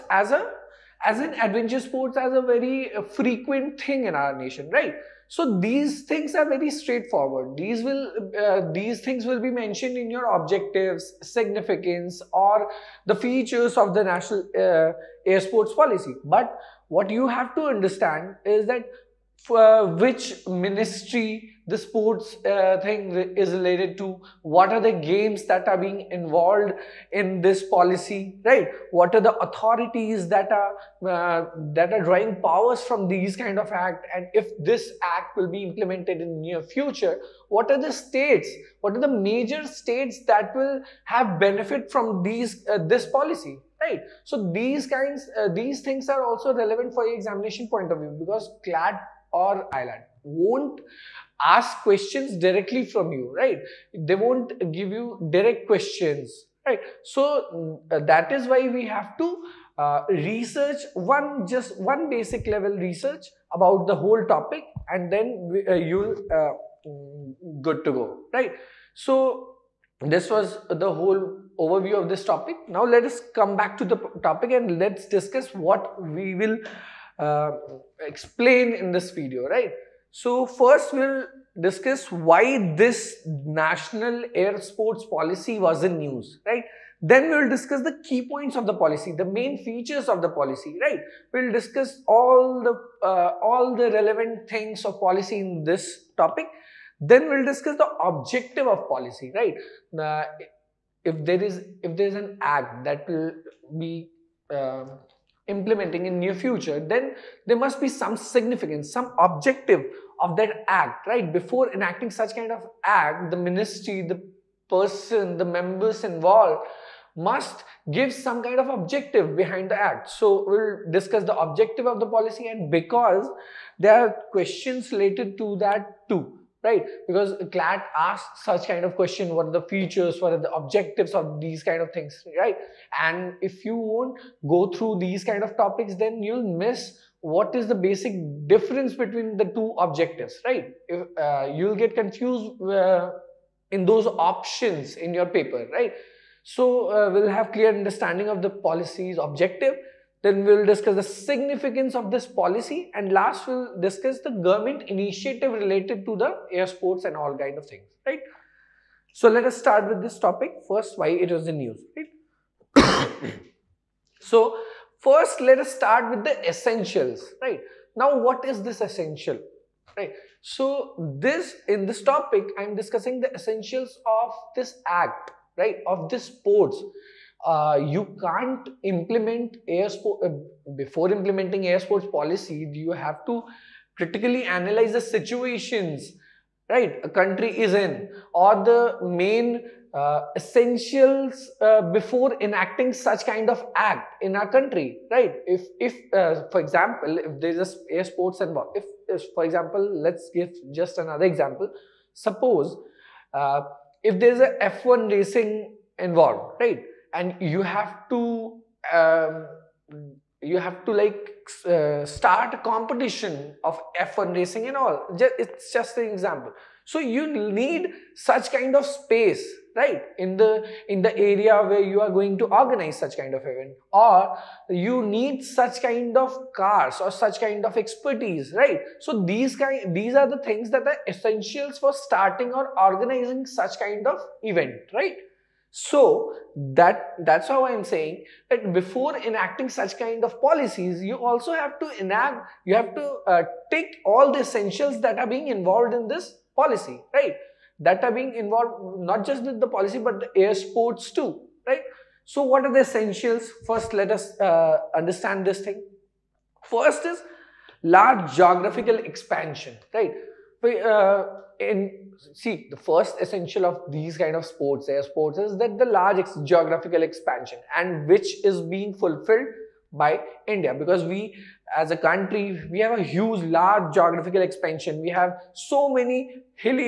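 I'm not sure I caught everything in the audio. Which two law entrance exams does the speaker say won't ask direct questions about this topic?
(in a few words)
CLAT or AILET.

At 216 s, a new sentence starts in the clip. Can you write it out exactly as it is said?
So you need such kind of space, right?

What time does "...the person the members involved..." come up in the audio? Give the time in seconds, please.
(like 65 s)
114 s.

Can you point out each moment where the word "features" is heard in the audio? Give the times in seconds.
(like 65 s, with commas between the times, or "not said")
13 s, 89 s, 129 s.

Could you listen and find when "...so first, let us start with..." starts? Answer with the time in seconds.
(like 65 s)
164 s.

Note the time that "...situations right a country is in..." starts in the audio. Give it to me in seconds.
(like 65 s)
185 s.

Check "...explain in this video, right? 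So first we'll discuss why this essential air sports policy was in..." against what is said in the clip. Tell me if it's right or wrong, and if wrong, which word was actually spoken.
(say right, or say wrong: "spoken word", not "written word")
wrong: "national", not "essential".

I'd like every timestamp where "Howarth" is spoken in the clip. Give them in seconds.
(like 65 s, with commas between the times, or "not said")
not said.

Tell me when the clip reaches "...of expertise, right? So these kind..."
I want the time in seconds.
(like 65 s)
227 s.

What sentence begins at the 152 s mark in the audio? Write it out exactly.
And last, we'll discuss the government initiative related to the air sports and all kind of things, right?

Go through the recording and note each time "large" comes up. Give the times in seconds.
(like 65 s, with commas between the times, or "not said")
257 s, 265 s, 273 s.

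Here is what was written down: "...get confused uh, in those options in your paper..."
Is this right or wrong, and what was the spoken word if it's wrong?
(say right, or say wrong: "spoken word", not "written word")
right.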